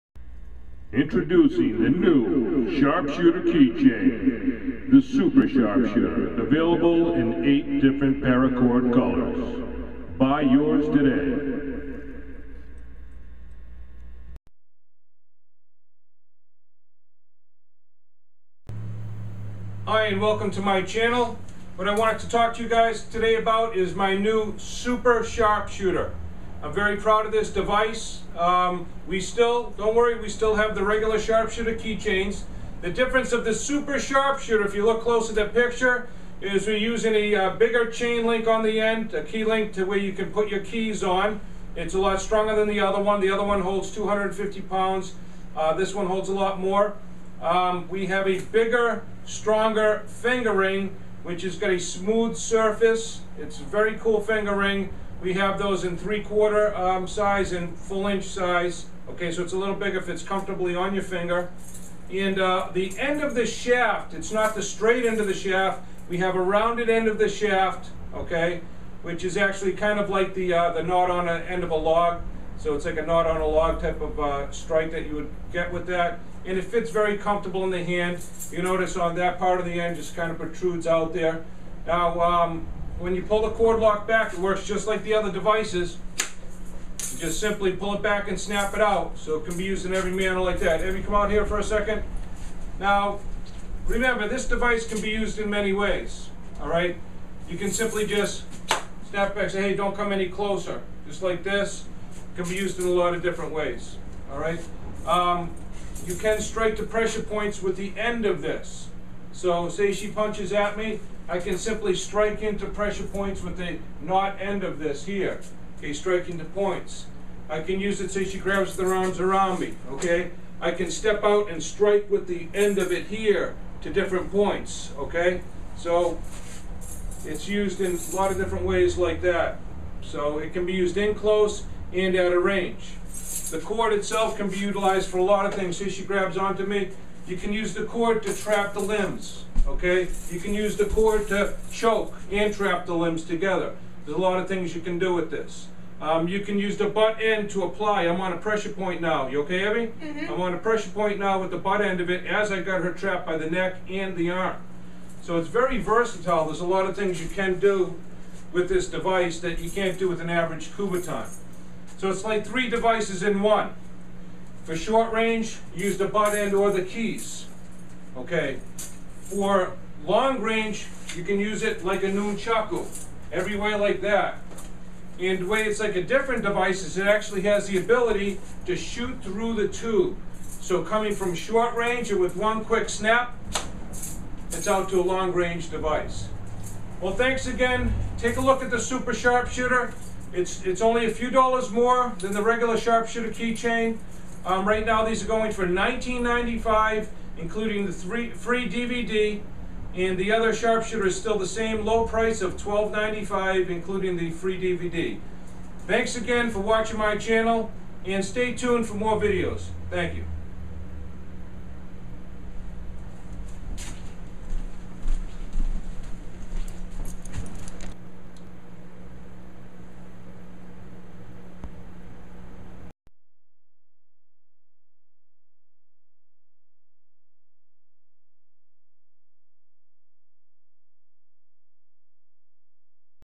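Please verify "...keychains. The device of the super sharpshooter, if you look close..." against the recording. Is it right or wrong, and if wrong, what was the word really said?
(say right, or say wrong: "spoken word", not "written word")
wrong: "difference", not "device".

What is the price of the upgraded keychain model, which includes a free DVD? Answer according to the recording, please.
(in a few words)
$19.95.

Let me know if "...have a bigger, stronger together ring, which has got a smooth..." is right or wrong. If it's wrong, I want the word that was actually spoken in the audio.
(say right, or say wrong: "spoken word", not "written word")
wrong: "finger", not "together".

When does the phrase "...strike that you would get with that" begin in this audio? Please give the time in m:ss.
1:14.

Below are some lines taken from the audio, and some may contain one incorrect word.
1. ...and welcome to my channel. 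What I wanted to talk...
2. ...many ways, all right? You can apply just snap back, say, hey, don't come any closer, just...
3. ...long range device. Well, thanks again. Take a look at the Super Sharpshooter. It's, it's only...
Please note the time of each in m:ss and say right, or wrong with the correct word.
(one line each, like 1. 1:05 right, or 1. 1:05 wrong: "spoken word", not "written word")
1. 0:20 right
2. 1:35 wrong: "simply", not "apply"
3. 3:05 right.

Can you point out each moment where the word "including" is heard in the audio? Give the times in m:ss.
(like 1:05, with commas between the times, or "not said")
3:17, 3:23.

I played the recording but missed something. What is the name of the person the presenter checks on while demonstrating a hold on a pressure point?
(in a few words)
Abby.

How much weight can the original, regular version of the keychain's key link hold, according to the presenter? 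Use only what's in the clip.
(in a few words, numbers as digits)
250 pounds.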